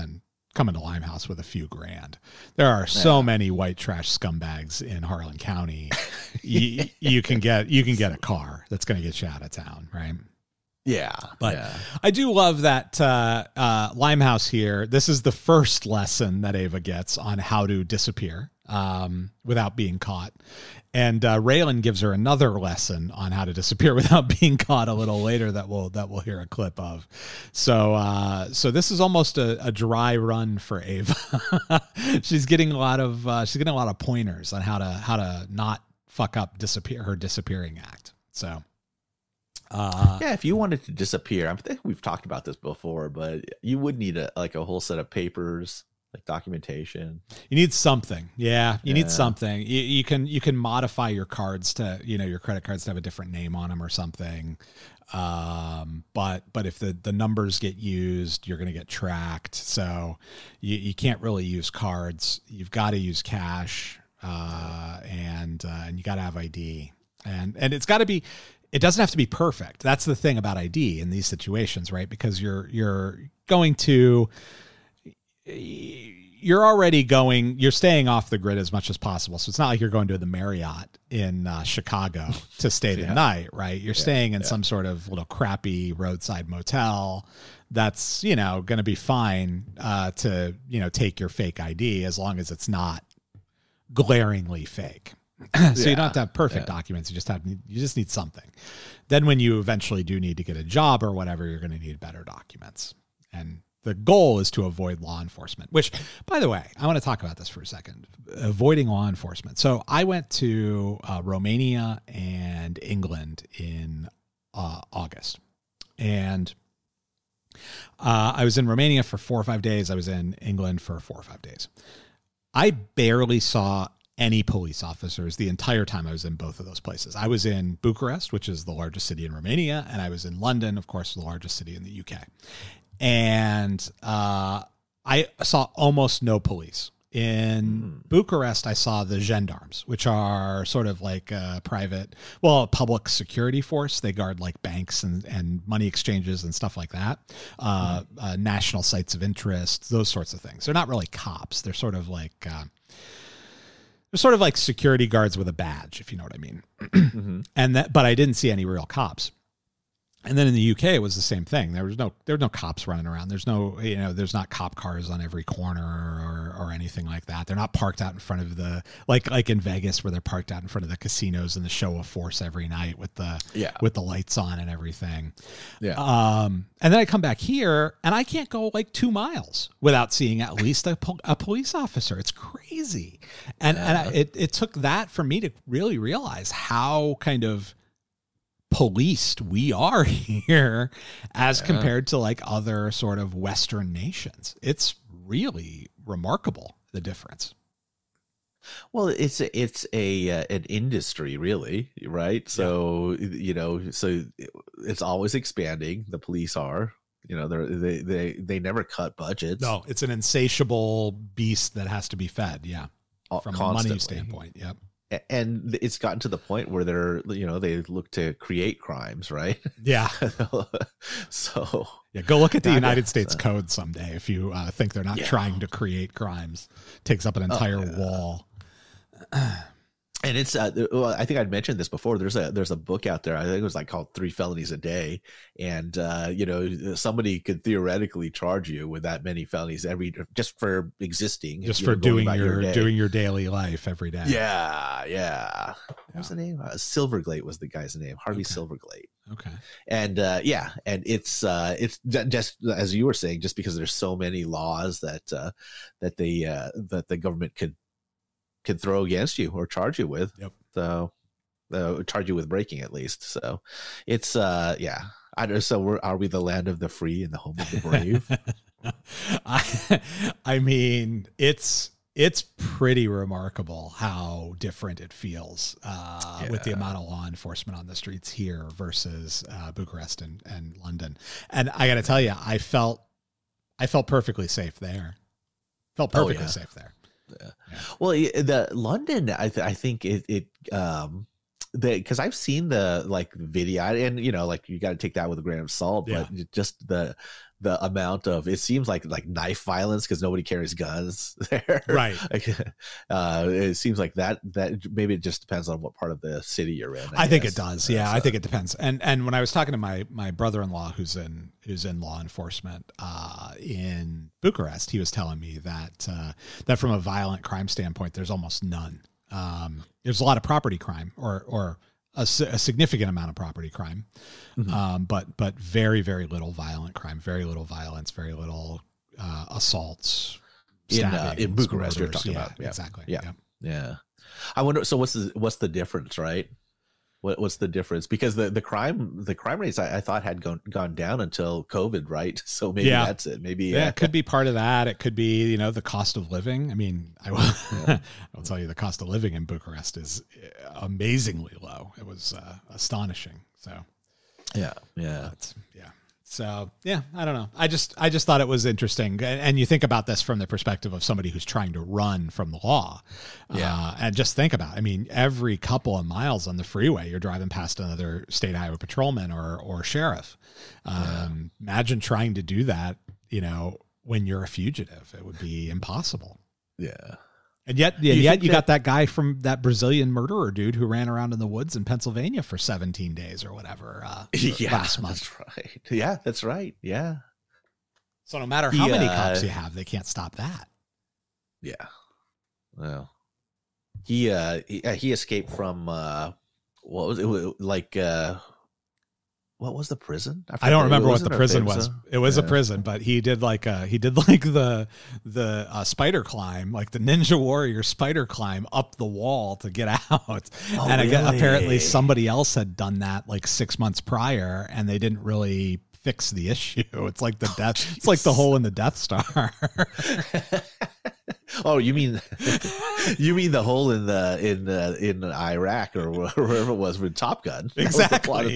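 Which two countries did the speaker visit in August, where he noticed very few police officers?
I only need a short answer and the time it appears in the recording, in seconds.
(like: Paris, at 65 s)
Romania and England, at 111 s.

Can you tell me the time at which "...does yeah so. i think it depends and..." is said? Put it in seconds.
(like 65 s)
307 s.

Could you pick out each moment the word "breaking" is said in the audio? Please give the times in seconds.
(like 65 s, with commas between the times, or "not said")
262 s.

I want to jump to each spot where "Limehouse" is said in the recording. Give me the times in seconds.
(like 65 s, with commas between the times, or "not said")
0 s, 13 s.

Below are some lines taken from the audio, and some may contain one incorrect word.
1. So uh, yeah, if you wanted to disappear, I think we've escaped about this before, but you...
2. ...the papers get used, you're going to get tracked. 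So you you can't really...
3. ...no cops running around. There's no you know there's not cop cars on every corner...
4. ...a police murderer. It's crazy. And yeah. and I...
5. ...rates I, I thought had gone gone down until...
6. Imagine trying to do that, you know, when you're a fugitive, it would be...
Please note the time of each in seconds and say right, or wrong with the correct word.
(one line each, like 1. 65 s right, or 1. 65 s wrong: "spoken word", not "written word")
1. 38 s wrong: "talked", not "escaped"
2. 57 s wrong: "numbers", not "papers"
3. 162 s right
4. 181 s wrong: "officer", not "murderer"
5. 339 s right
6. 371 s right.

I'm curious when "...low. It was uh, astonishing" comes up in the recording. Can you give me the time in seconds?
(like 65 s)
351 s.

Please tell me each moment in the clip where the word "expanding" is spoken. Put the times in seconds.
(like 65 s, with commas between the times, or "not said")
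205 s.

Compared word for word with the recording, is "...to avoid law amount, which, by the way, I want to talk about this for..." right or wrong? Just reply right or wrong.
wrong.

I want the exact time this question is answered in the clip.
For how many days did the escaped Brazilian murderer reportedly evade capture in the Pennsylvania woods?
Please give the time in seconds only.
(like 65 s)
382 s.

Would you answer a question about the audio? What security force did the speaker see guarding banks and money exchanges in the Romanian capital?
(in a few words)
gendarmes.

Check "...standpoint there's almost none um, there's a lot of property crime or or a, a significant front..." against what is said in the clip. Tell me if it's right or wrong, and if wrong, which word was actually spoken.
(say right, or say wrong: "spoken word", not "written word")
wrong: "amount", not "front".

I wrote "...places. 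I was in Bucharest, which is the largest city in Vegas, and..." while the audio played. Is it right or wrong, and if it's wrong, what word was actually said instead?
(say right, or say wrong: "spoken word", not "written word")
wrong: "Romania", not "Vegas".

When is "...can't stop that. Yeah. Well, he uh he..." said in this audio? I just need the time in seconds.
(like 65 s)
389 s.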